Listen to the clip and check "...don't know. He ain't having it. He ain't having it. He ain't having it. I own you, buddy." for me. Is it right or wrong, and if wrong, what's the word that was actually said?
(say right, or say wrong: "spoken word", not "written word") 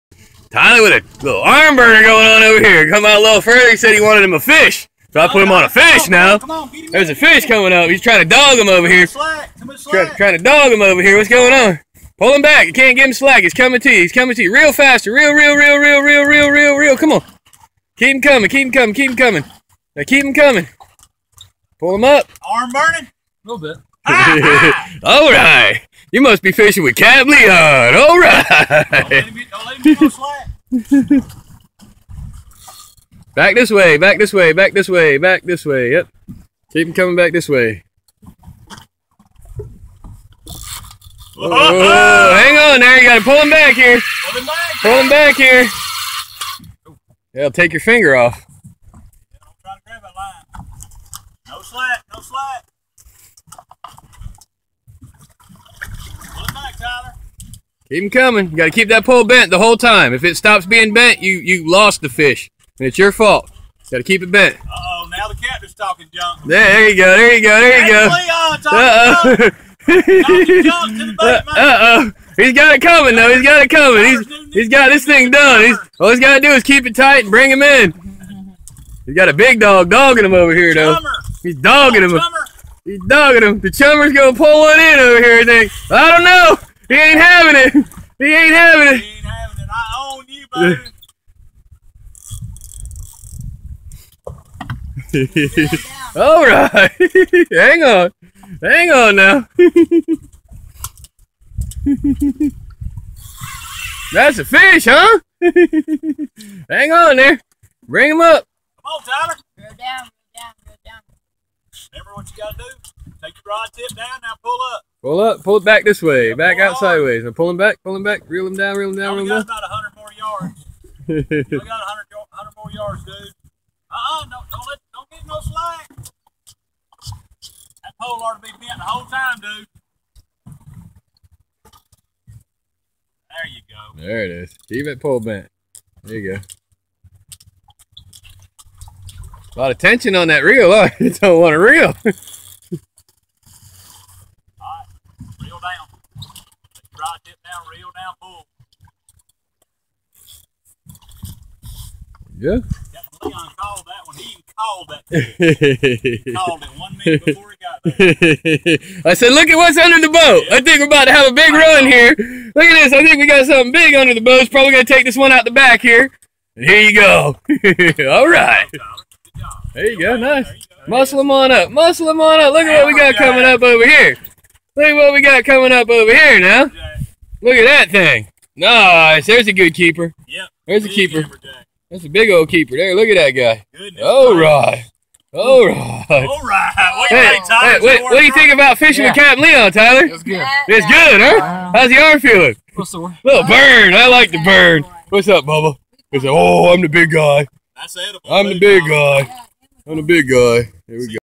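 right.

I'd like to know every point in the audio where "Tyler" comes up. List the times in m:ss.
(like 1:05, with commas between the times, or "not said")
0:00, 1:49, 3:09.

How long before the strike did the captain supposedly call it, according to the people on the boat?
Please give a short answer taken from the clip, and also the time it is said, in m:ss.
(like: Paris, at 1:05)
1 minute, at 2:36.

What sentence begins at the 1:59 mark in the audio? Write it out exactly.
We got about 100 more yards.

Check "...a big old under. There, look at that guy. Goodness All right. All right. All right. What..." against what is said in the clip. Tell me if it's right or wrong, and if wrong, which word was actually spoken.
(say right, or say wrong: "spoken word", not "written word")
wrong: "keeper", not "under".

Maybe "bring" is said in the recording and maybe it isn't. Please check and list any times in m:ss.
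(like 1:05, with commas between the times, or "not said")
1:17, 1:47.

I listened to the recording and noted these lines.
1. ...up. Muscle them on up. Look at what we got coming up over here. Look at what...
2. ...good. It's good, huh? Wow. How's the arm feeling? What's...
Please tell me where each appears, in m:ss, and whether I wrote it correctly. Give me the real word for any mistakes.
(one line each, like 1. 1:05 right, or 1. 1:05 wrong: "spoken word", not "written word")
1. 2:51 right
2. 3:10 right.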